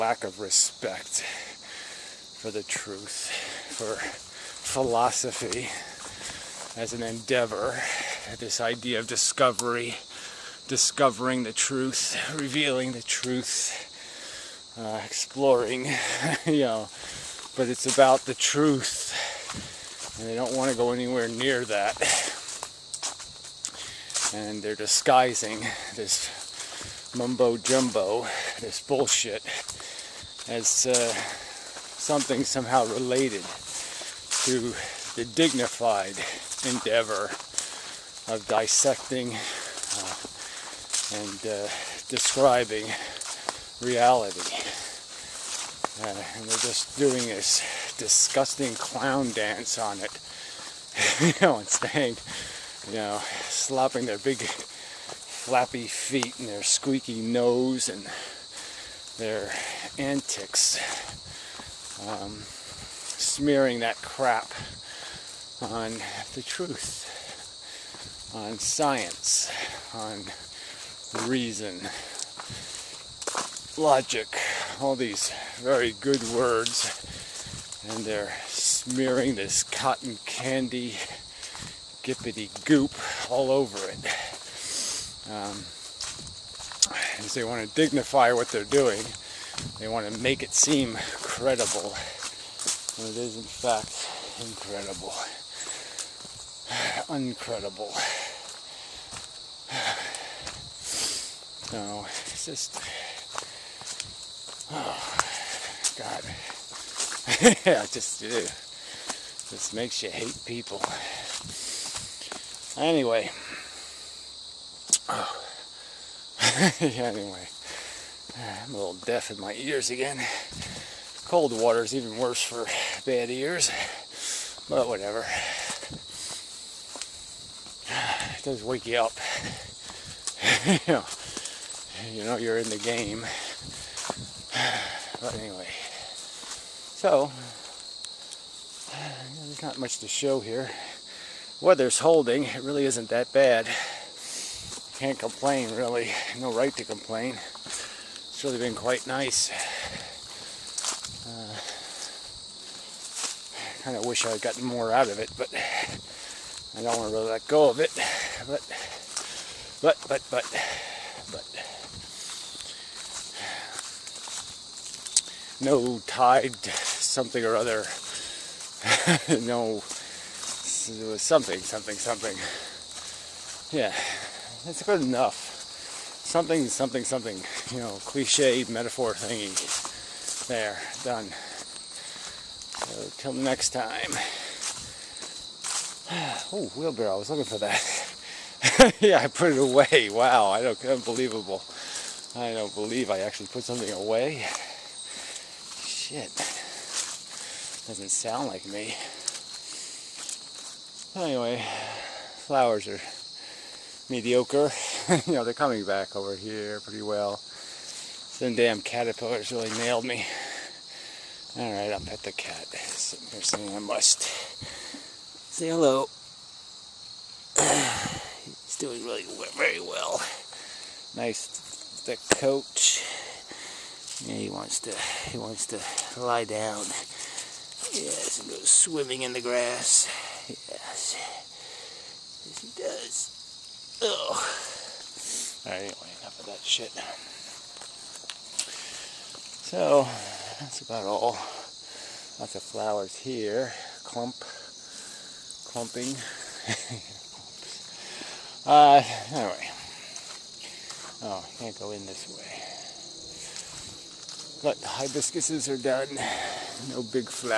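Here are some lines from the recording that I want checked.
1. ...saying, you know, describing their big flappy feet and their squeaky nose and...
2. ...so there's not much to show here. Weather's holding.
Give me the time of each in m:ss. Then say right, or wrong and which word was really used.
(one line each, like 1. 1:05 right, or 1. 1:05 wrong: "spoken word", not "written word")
1. 0:51 wrong: "slapping", not "describing"
2. 2:15 right.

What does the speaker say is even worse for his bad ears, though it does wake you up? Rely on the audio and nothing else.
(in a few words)
cold water.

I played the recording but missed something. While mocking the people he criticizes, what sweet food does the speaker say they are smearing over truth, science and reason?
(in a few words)
cotton candy.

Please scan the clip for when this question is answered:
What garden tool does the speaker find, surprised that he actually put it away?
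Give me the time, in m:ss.
3:06.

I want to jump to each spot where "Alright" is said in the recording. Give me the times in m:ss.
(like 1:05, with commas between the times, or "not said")
3:31, 3:55.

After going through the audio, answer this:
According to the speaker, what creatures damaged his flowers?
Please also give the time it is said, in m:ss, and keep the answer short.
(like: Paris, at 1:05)
caterpillars, at 3:28.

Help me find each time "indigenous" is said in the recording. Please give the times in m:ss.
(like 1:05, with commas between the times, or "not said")
not said.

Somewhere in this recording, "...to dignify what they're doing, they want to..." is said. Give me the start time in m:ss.
1:27.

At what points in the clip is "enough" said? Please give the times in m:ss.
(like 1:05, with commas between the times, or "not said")
2:55, 3:56.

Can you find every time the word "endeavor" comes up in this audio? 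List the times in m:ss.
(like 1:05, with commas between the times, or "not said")
0:07, 0:36.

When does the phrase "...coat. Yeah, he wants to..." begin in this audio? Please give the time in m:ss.
3:42.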